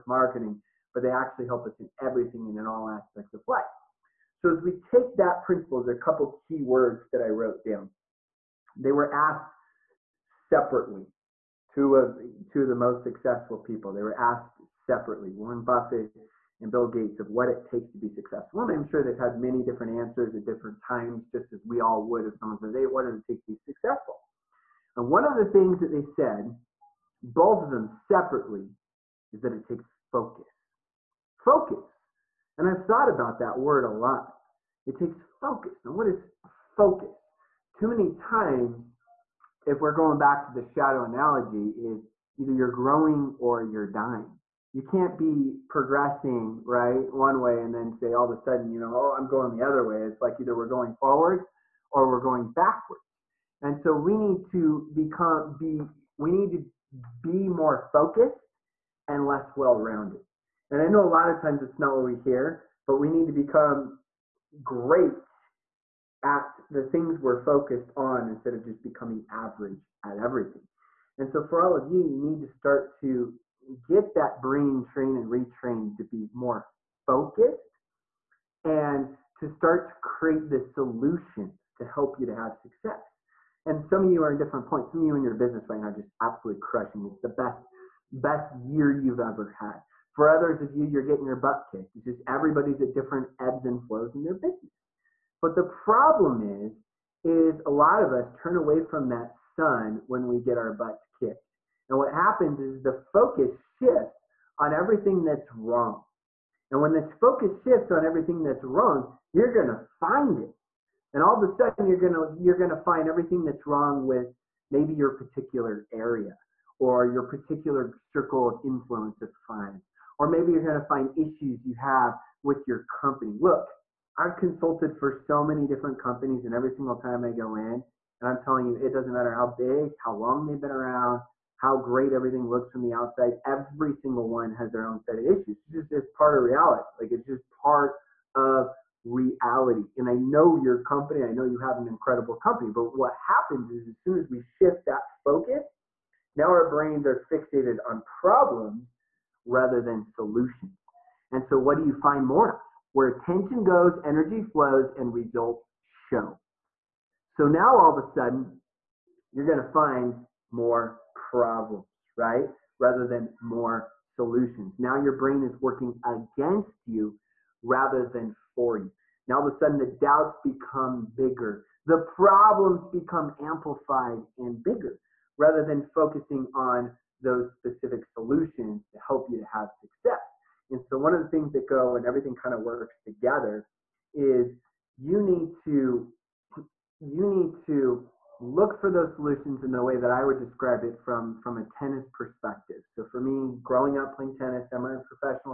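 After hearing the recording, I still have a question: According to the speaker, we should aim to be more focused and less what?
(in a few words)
well-rounded.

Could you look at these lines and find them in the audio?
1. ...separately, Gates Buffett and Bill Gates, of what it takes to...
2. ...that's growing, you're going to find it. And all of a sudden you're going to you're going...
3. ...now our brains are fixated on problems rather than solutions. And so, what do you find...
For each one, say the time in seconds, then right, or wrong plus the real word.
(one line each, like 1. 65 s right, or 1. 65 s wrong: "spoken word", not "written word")
1. 14 s wrong: "Warren", not "Gates"
2. 108 s wrong: "wrong", not "growing"
3. 146 s right.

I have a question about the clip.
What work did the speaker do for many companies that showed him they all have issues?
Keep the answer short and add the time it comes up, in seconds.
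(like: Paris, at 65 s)
consulted, at 124 s.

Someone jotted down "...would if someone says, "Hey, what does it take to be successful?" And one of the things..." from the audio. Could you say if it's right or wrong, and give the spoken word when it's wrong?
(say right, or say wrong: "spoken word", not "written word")
right.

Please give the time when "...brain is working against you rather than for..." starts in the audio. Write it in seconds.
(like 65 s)
165 s.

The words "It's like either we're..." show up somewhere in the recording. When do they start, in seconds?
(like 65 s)
50 s.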